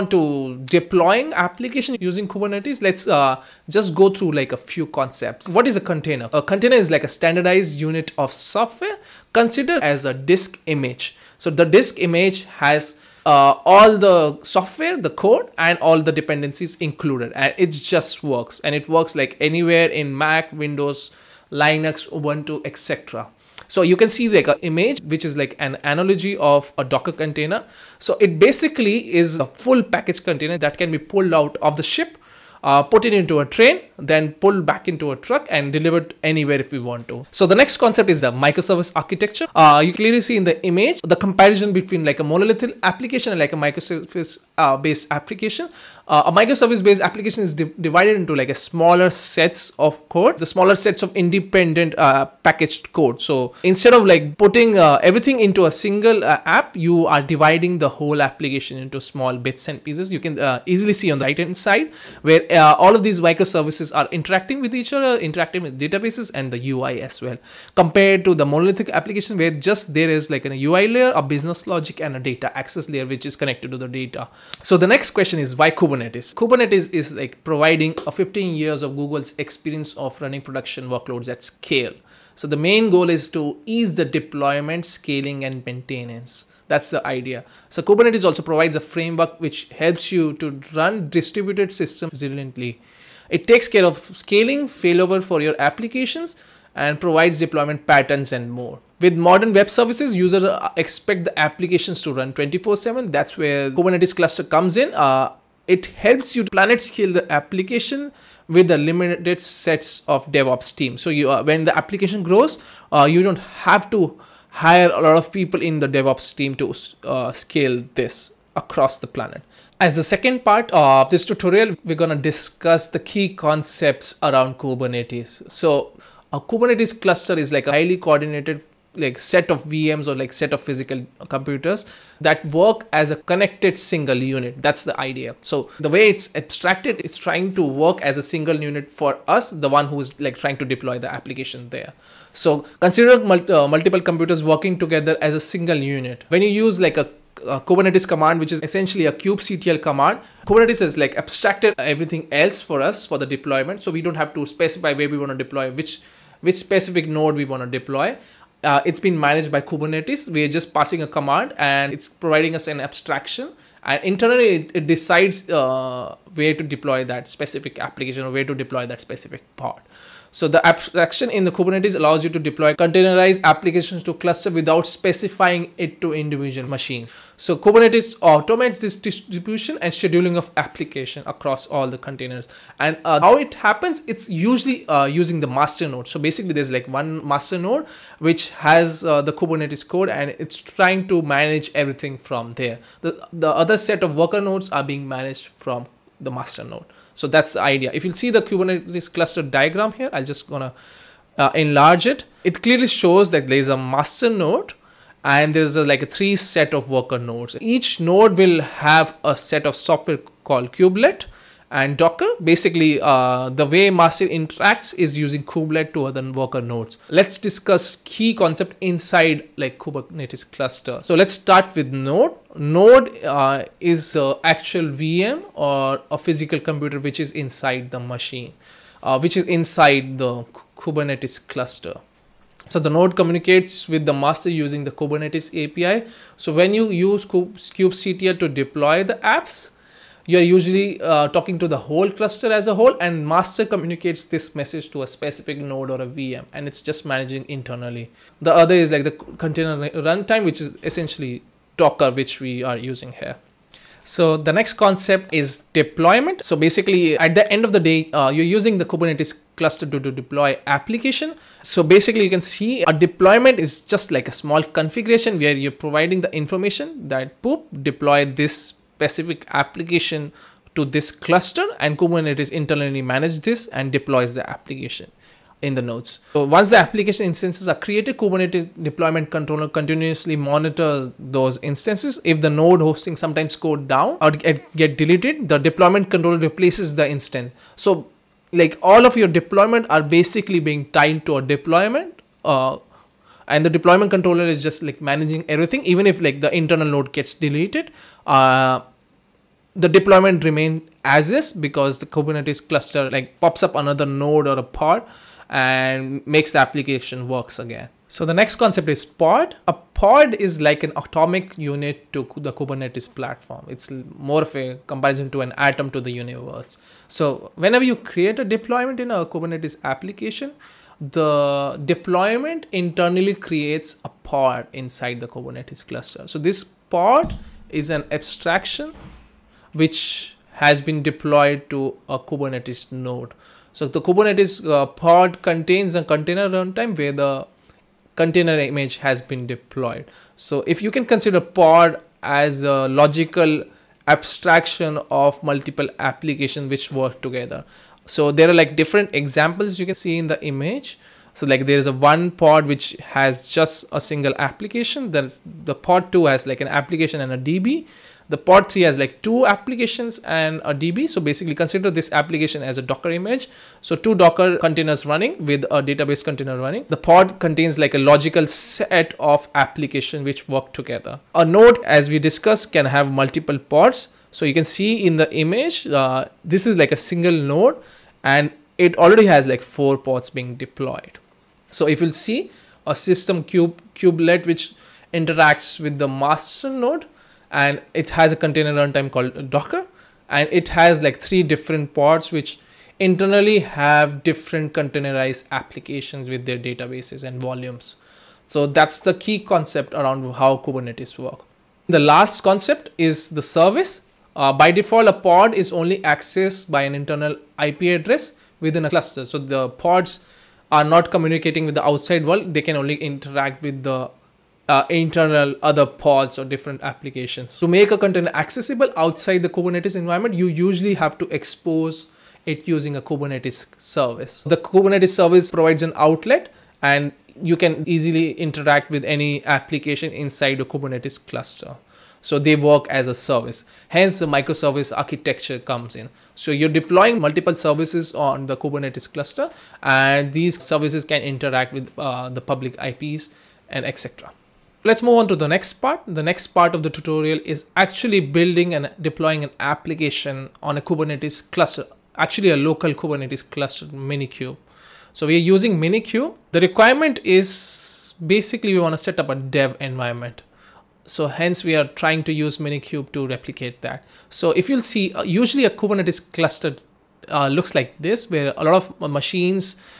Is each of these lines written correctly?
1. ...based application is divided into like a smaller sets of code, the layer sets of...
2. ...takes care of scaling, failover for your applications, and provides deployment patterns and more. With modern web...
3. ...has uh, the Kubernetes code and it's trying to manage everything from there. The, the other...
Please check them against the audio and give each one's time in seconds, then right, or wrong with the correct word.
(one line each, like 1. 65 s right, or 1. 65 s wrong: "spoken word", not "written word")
1. 46 s wrong: "smaller", not "layer"
2. 93 s right
3. 188 s right.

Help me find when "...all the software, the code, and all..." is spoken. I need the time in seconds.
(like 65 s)
13 s.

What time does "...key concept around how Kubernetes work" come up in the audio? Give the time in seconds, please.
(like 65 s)
399 s.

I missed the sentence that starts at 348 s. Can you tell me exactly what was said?
So there are like different examples you can see in the image.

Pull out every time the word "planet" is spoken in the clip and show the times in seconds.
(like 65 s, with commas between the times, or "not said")
106 s, 119 s.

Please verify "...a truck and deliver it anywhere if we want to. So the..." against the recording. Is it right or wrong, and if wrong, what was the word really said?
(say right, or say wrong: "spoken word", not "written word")
right.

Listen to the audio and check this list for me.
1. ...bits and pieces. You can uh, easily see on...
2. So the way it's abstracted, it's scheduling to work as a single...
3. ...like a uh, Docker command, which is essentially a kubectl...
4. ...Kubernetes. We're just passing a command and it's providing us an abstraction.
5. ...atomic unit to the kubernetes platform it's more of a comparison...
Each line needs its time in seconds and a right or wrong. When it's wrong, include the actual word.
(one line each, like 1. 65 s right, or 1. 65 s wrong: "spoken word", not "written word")
1. 59 s right
2. 135 s wrong: "trying", not "scheduling"
3. 146 s wrong: "Kubernetes", not "Docker"
4. 159 s right
5. 310 s right.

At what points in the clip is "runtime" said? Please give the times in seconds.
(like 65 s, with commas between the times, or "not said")
250 s, 336 s, 388 s.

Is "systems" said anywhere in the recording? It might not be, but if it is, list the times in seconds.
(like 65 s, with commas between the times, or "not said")
91 s, 382 s.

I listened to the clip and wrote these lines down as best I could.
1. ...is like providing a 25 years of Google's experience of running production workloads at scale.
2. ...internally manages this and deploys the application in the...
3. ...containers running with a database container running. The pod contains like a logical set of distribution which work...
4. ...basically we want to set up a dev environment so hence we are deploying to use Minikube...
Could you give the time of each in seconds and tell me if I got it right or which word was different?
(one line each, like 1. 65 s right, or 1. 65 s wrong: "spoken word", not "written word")
1. 76 s wrong: "15", not "25"
2. 272 s right
3. 364 s wrong: "application", not "distribution"
4. 458 s wrong: "trying", not "deploying".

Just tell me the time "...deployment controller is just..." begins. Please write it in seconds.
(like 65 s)
293 s.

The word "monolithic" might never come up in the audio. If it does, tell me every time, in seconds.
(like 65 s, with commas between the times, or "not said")
42 s, 68 s.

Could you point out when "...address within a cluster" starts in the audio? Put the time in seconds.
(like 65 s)
408 s.